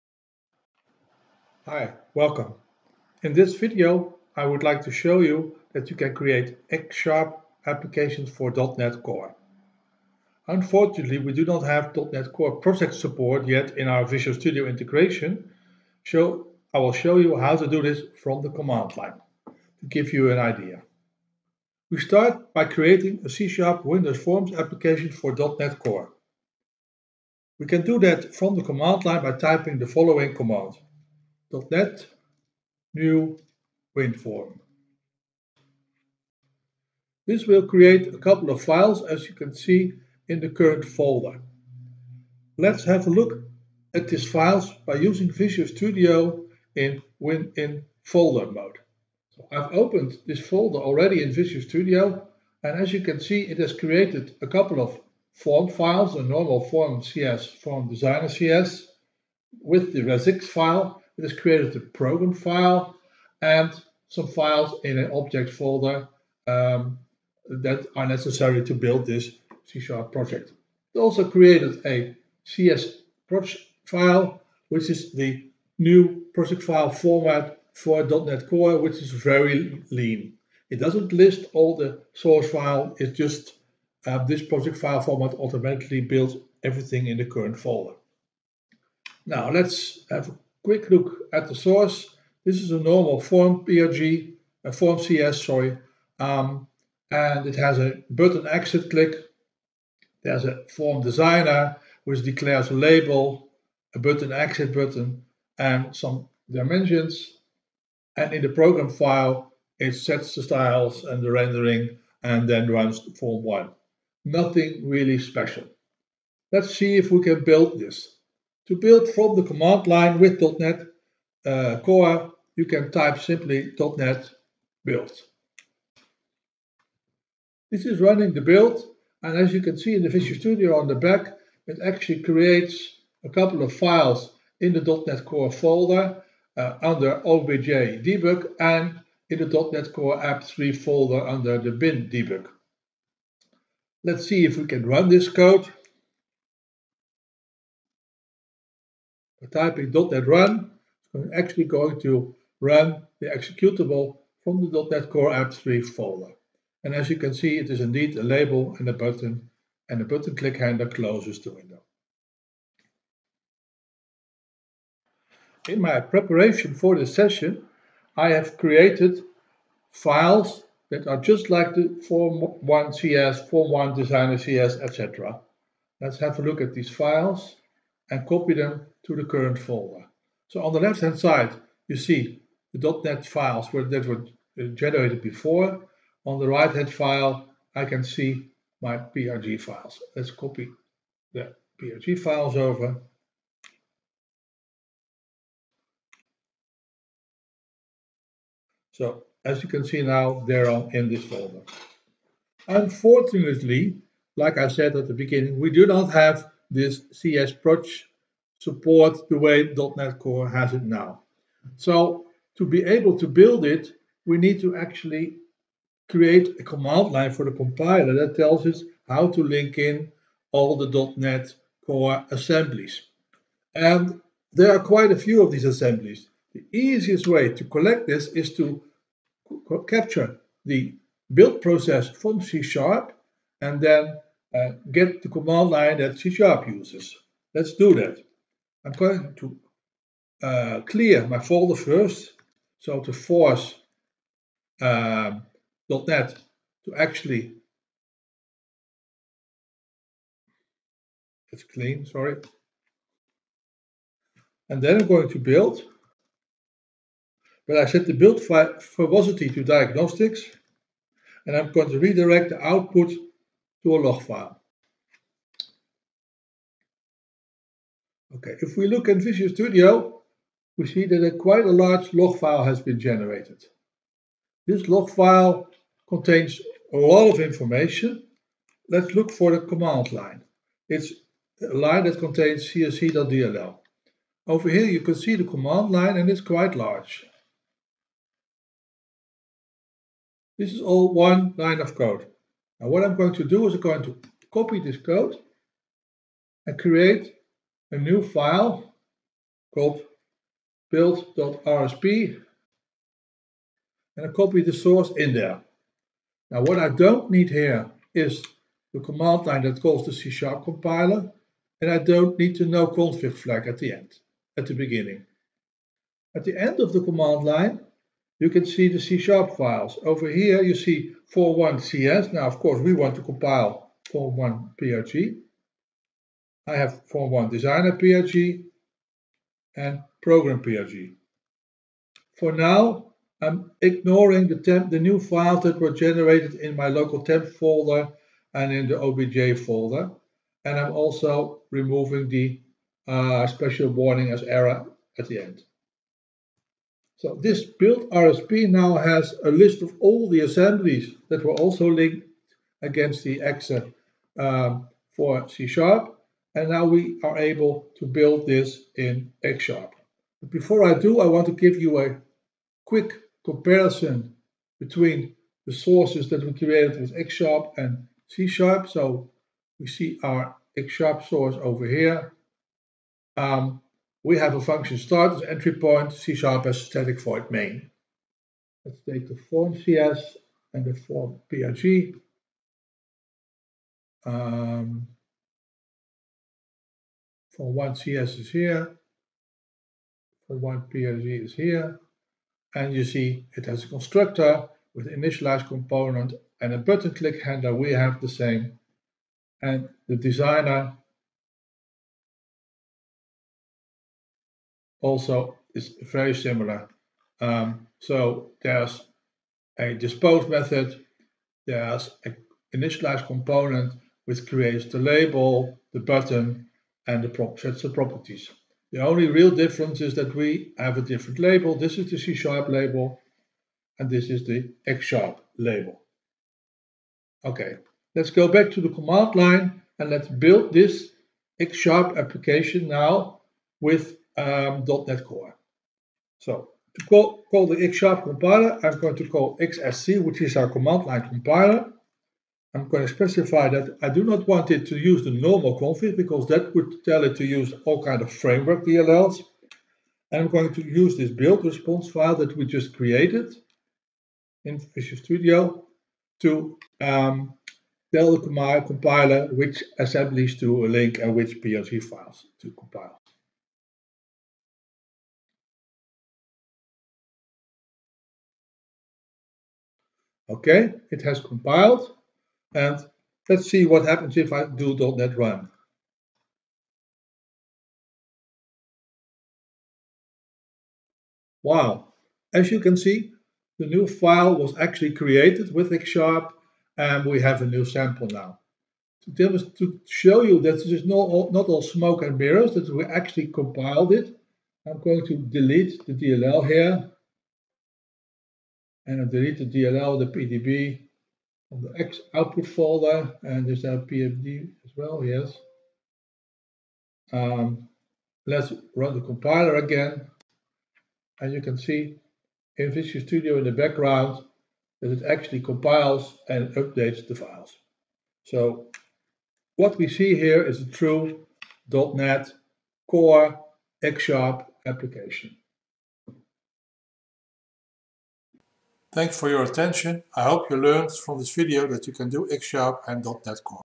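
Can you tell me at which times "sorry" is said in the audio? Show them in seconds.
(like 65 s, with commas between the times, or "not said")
95 s, 252 s.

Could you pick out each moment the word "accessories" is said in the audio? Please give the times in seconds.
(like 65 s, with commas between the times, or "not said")
not said.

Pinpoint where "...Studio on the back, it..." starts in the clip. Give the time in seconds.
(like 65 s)
130 s.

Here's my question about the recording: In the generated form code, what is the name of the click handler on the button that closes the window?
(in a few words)
button exit click.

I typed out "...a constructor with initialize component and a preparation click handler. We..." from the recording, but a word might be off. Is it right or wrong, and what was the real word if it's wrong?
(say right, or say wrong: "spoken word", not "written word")
wrong: "button", not "preparation".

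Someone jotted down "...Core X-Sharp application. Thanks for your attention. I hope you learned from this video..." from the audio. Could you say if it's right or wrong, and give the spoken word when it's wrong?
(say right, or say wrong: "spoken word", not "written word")
right.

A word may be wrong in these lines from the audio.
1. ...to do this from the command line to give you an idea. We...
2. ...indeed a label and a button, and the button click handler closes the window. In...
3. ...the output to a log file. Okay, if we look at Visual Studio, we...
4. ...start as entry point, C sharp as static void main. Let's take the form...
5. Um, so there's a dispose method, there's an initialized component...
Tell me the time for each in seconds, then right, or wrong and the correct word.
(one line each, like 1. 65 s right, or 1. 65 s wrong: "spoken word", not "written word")
1. 17 s right
2. 157 s right
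3. 262 s right
4. 374 s right
5. 407 s right.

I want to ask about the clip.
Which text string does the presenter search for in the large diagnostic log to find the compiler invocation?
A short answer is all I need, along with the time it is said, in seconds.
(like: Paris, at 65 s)
csc.dll, at 282 s.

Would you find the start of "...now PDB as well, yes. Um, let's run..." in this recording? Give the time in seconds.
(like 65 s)
503 s.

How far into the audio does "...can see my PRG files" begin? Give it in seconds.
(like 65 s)
187 s.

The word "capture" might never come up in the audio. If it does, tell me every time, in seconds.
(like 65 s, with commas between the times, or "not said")
229 s.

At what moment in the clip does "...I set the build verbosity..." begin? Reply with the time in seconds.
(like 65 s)
257 s.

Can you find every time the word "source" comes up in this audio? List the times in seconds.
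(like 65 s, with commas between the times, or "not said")
82 s, 91 s, 304 s, 365 s, 371 s.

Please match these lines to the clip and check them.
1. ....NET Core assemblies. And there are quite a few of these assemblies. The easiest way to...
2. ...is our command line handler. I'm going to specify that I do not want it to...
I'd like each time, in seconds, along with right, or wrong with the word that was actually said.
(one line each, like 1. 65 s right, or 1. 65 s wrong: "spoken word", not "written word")
1. 221 s right
2. 440 s wrong: "compiler", not "handler".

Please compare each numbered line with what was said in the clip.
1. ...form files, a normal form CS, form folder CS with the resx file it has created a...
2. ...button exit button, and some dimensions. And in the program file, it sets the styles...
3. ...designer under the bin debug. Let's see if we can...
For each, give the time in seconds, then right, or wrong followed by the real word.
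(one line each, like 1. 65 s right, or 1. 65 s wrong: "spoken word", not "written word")
1. 55 s wrong: "designer", not "folder"
2. 103 s right
3. 140 s wrong: "folder", not "designer".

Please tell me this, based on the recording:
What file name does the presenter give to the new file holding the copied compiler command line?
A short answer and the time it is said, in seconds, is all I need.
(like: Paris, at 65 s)
build.rsp, at 300 s.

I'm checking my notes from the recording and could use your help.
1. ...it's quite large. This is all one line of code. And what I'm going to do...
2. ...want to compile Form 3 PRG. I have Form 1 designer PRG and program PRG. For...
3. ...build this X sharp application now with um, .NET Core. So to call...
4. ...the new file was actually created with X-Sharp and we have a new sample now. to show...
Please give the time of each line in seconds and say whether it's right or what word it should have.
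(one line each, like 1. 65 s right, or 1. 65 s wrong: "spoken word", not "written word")
1. 286 s right
2. 322 s wrong: "1", not "3"
3. 430 s right
4. 483 s right.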